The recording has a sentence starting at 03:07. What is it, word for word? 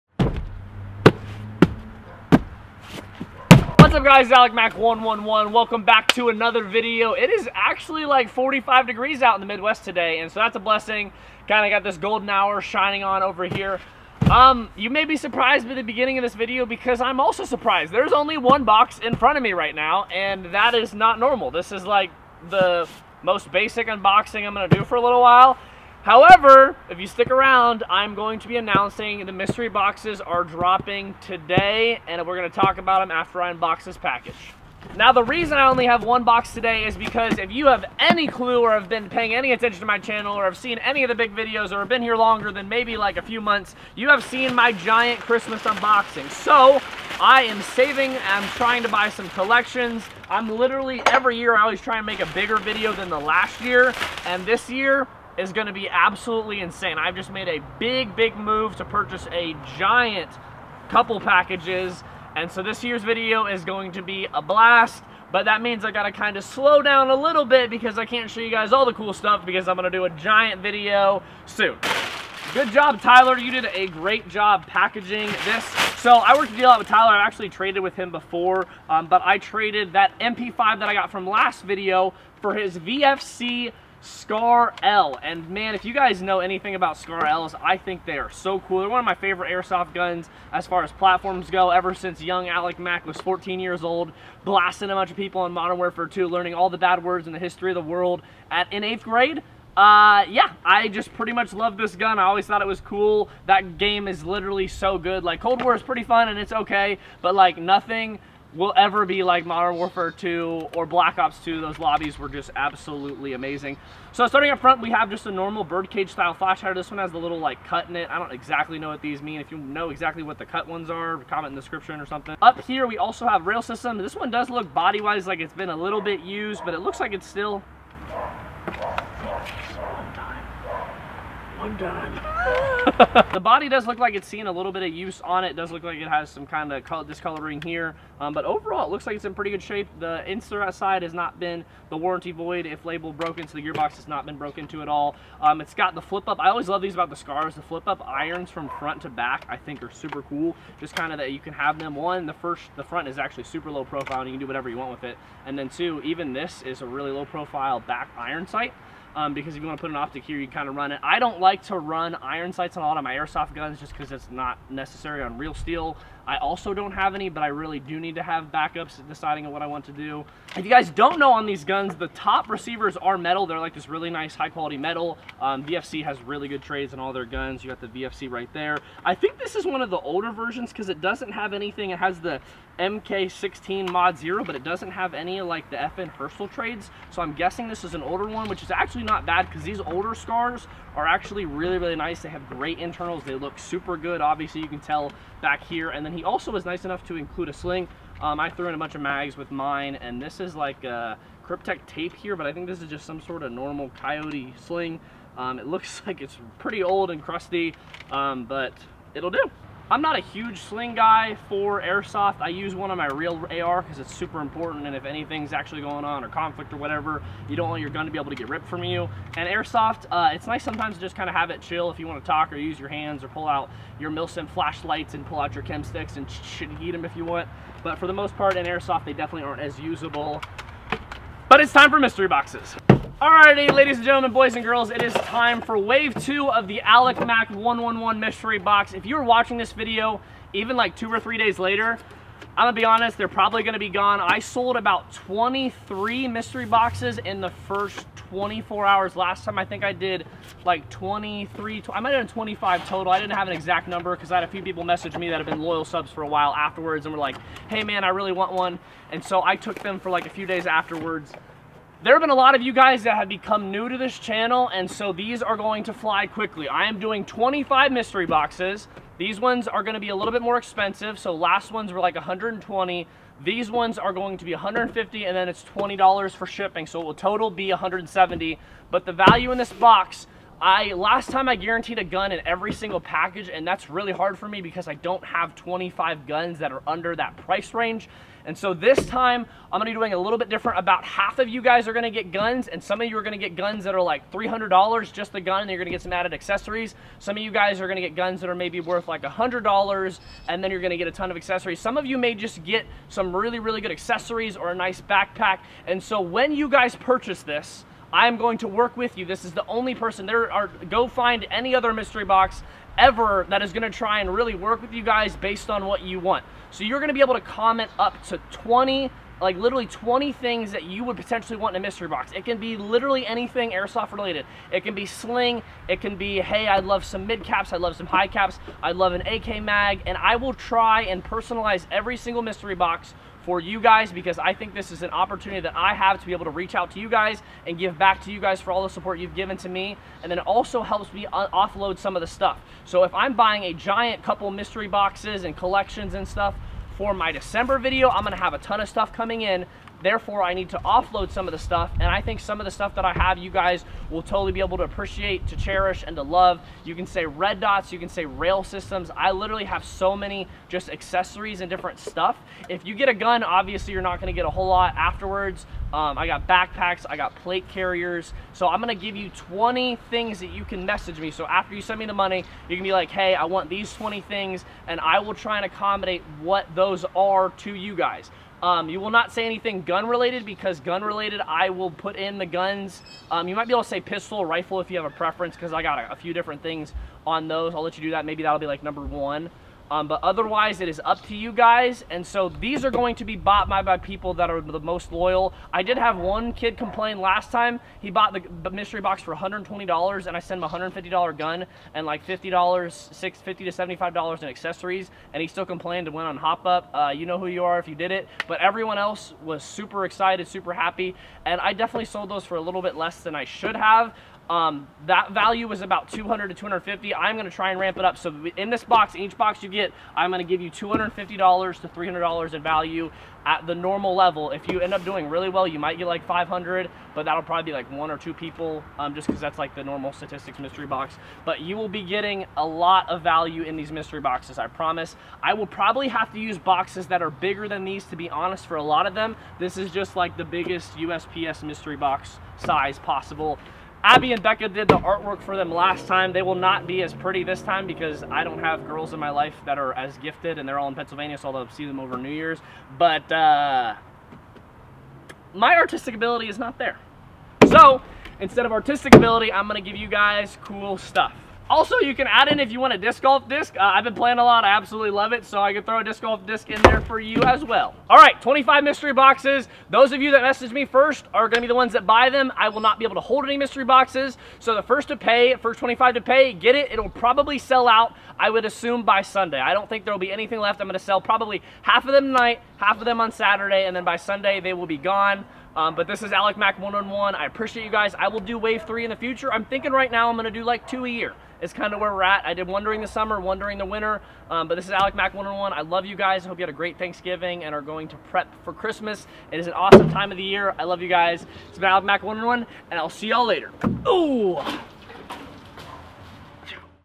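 So I'm guessing this is an older one, which is actually not bad because these older Scars are actually really, really nice.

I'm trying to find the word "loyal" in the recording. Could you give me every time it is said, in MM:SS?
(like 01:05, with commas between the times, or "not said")
04:15, 06:35.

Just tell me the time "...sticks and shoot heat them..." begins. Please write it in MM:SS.
03:45.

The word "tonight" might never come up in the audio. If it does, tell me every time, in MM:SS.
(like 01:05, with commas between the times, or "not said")
08:02.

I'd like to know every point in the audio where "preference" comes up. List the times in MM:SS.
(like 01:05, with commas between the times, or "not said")
06:25.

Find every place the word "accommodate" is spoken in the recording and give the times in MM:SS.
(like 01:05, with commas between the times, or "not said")
06:15.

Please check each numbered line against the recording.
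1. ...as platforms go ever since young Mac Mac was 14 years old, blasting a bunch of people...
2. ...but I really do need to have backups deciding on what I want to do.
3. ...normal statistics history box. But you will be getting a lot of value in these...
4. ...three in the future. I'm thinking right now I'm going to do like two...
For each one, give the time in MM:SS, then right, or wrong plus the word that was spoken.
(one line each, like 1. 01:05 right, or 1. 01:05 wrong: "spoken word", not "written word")
1. 01:30 wrong: "Alec", not "Mac"
2. 02:47 right
3. 07:09 wrong: "mystery", not "history"
4. 08:08 right.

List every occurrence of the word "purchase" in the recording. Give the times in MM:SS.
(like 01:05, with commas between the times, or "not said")
00:58, 05:06.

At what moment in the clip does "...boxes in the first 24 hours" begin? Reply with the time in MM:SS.
04:06.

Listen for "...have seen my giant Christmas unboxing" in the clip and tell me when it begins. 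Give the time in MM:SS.
00:44.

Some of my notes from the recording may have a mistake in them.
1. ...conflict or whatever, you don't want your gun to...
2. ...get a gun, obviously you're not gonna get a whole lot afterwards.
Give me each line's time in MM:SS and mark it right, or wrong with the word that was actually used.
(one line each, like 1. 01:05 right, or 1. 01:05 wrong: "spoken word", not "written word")
1. 03:36 right
2. 06:02 right.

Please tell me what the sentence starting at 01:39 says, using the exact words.
Uh, yeah, I just pretty much love this gun.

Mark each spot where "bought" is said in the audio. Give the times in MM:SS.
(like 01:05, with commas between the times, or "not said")
06:33, 06:38.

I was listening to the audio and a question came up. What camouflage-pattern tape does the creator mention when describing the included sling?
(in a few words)
Kryptek.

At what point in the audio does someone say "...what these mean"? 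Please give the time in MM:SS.
01:58.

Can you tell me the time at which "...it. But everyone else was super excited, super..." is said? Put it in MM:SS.
06:48.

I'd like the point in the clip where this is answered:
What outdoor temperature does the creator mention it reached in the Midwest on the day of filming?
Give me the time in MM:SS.
00:08.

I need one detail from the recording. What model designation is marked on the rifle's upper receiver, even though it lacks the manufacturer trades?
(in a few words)
MK16 Mod 0.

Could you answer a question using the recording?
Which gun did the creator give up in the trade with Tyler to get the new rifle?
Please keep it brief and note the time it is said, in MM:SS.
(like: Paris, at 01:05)
MP5, at 01:20.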